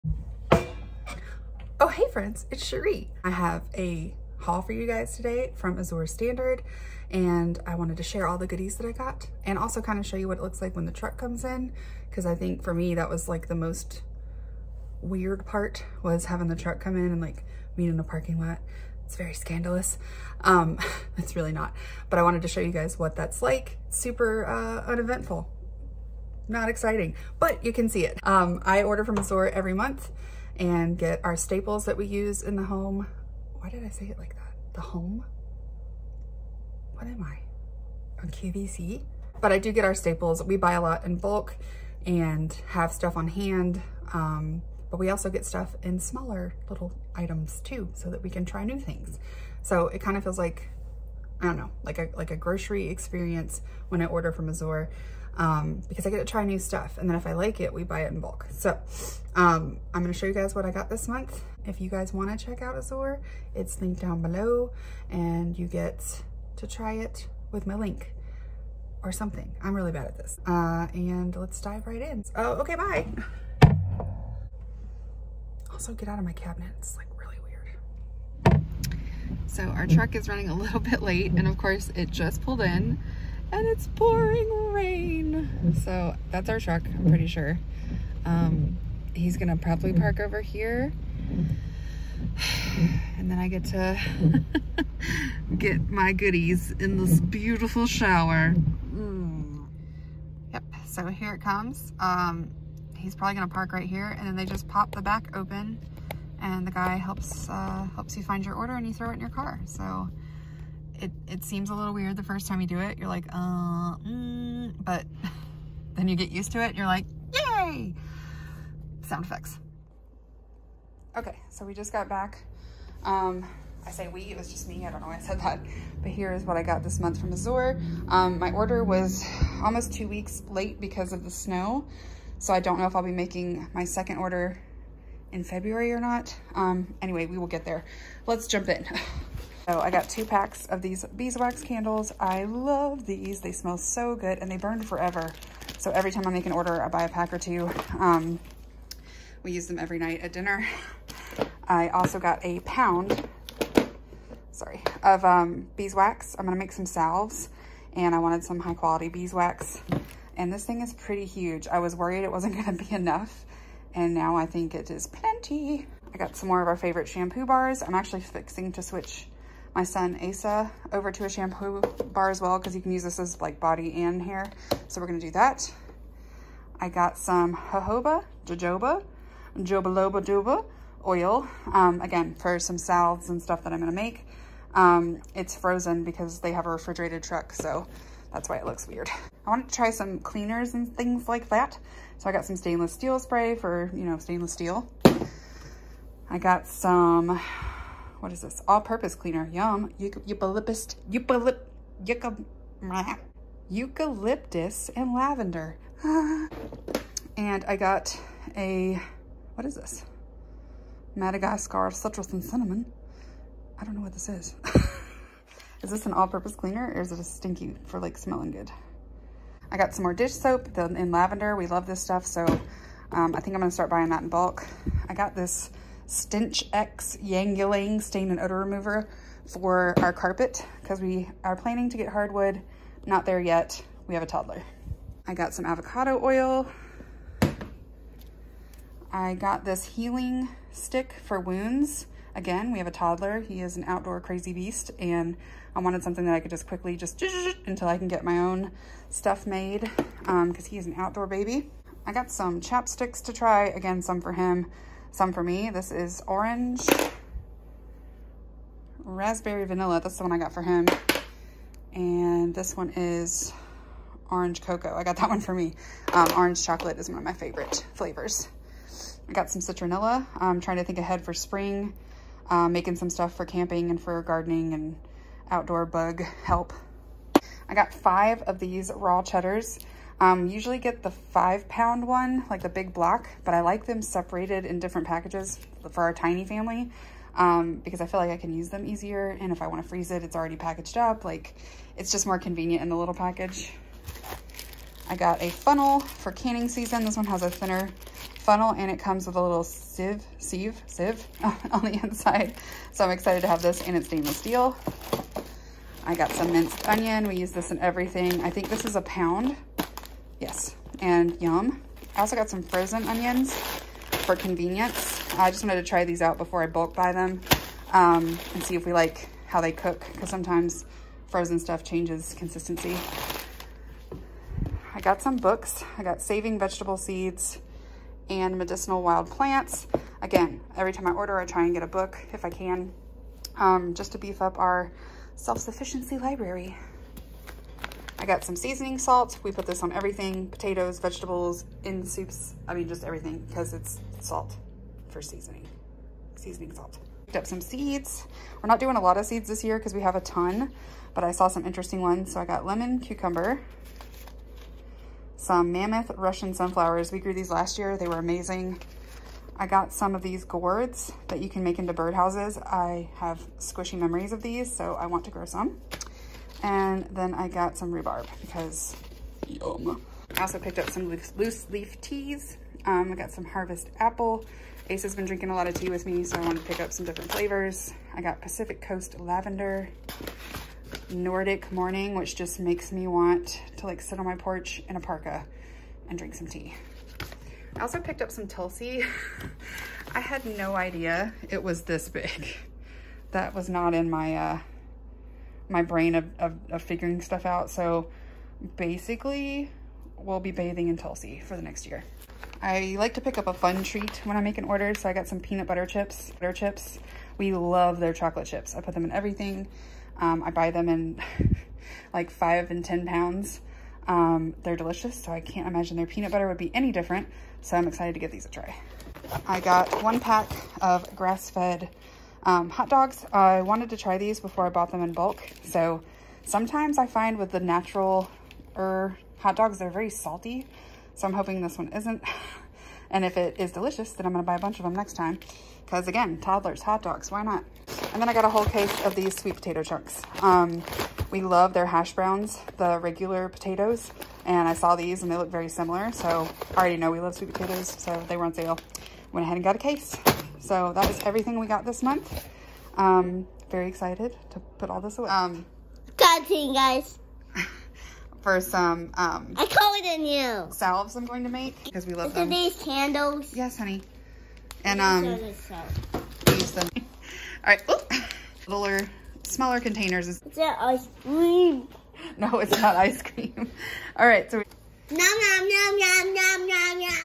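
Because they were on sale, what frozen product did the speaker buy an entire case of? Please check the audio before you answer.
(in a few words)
Sweet potato chunks.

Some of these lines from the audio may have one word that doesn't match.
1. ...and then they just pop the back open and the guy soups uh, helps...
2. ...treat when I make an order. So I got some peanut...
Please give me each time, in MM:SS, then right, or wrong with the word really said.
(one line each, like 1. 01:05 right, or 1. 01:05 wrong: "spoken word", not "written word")
1. 01:44 wrong: "helps", not "soups"
2. 06:43 right.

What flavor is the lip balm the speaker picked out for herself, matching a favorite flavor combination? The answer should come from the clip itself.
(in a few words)
Orange cocoa.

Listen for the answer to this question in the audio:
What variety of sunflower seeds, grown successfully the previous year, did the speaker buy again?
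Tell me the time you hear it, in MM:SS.
05:55.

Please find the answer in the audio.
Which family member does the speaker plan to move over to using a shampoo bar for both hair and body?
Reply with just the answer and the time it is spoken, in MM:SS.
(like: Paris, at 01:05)
Asa, at 02:50.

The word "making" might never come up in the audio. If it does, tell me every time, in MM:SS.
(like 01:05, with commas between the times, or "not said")
02:13, 04:32.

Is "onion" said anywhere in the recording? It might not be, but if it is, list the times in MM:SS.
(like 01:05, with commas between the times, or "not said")
05:06, 05:13.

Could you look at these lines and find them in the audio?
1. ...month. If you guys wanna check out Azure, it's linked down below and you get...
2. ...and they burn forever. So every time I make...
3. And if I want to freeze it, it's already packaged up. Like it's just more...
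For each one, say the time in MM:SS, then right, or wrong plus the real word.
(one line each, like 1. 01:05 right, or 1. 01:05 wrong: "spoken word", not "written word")
1. 01:01 right
2. 02:24 right
3. 04:49 right.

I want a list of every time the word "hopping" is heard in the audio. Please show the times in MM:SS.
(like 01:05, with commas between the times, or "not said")
not said.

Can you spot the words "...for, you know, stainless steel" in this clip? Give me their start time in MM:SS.
03:13.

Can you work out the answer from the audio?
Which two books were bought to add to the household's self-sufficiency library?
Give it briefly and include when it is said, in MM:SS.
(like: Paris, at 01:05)
Saving Vegetable Seeds and Medicinal Wild Plants, at 05:26.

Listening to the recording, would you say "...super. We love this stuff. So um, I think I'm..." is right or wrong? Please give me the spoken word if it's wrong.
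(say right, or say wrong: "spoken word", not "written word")
wrong: "lavender", not "super".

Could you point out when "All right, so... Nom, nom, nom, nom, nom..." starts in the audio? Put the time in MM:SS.
07:54.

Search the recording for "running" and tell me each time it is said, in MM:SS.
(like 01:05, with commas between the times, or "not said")
01:20.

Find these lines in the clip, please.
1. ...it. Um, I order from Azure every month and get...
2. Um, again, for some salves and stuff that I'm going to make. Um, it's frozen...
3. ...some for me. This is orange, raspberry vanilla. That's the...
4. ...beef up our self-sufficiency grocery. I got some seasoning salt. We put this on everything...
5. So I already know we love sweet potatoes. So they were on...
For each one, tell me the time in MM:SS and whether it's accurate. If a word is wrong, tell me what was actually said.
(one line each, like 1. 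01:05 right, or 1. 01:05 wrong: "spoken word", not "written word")
1. 00:28 right
2. 03:01 right
3. 04:15 right
4. 05:34 wrong: "library", not "grocery"
5. 07:26 right.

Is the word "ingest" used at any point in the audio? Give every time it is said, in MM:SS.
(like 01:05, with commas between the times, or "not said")
not said.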